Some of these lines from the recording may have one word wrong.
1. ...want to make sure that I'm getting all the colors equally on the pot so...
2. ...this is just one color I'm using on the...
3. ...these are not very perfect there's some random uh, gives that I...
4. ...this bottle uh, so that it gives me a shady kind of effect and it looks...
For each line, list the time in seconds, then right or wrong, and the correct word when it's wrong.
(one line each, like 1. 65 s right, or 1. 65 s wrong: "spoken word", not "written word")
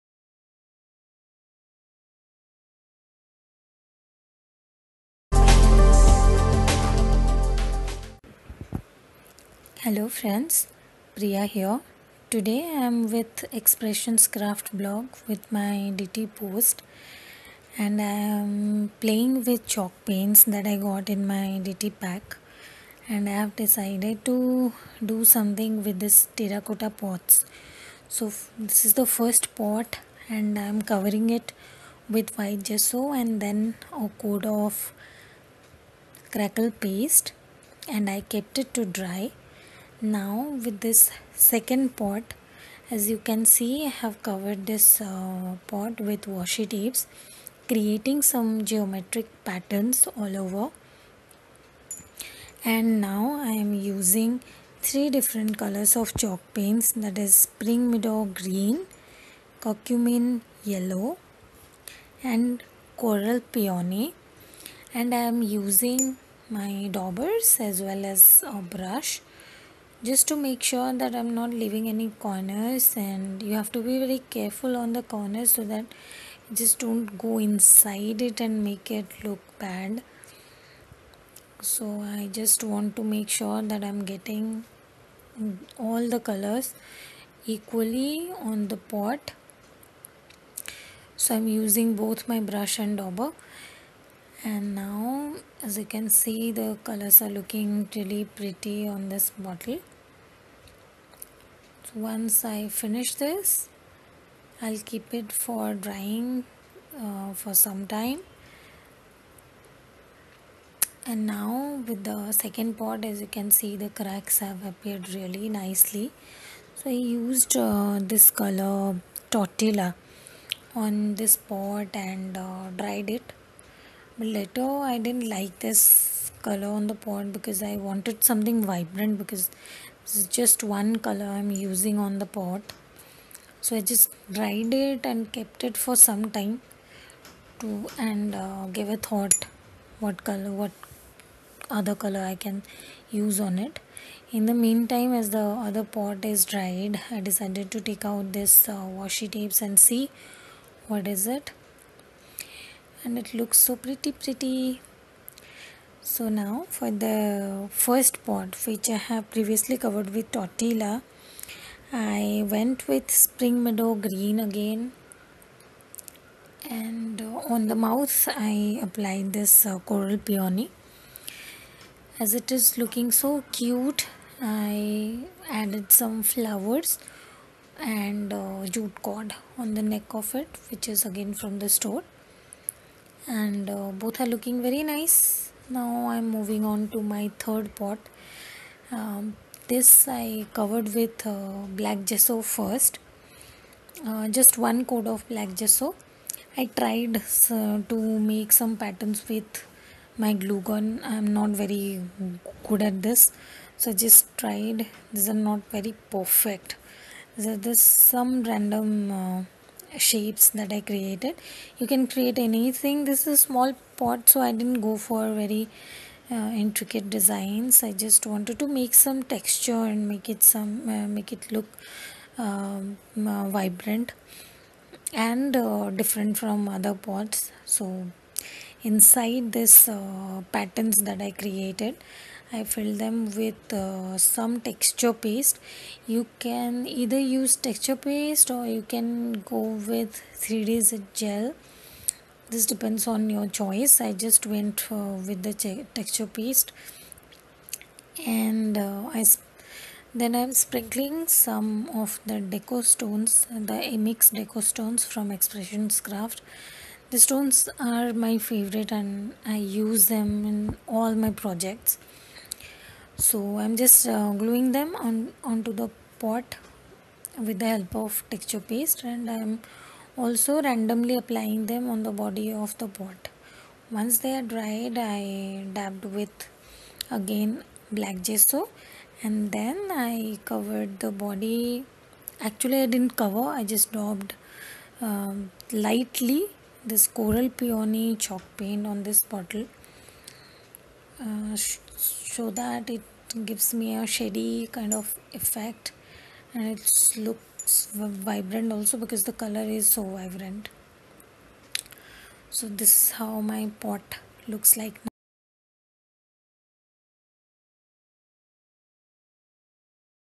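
1. 82 s right
2. 130 s right
3. 205 s wrong: "shapes", not "gives"
4. 289 s right.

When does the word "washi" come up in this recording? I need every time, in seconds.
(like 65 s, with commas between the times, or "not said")
46 s, 148 s.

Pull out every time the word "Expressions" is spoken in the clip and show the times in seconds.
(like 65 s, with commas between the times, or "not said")
13 s, 255 s.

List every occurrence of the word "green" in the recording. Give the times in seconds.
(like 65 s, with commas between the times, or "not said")
58 s, 163 s.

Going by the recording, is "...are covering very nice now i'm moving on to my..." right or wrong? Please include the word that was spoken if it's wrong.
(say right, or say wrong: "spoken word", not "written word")
wrong: "looking", not "covering".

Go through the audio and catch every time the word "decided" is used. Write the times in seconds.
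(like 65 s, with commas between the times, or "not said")
23 s, 147 s.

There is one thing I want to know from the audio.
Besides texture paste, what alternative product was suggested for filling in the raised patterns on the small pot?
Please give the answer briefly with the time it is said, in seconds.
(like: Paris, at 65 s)
3D gel, at 240 s.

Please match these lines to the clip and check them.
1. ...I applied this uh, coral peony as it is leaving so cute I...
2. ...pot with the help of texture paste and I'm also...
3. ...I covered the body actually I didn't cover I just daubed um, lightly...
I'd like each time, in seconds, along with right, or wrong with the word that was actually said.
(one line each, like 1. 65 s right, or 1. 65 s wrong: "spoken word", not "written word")
1. 168 s wrong: "looking", not "leaving"
2. 266 s right
3. 280 s right.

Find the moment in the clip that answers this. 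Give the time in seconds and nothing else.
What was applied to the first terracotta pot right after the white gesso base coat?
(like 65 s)
36 s.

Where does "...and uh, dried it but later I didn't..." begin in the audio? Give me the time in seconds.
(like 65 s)
121 s.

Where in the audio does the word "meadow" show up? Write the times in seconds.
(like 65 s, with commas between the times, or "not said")
57 s, 163 s.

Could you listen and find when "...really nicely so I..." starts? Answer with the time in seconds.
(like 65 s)
115 s.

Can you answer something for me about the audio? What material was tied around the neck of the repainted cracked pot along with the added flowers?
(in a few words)
jute cord.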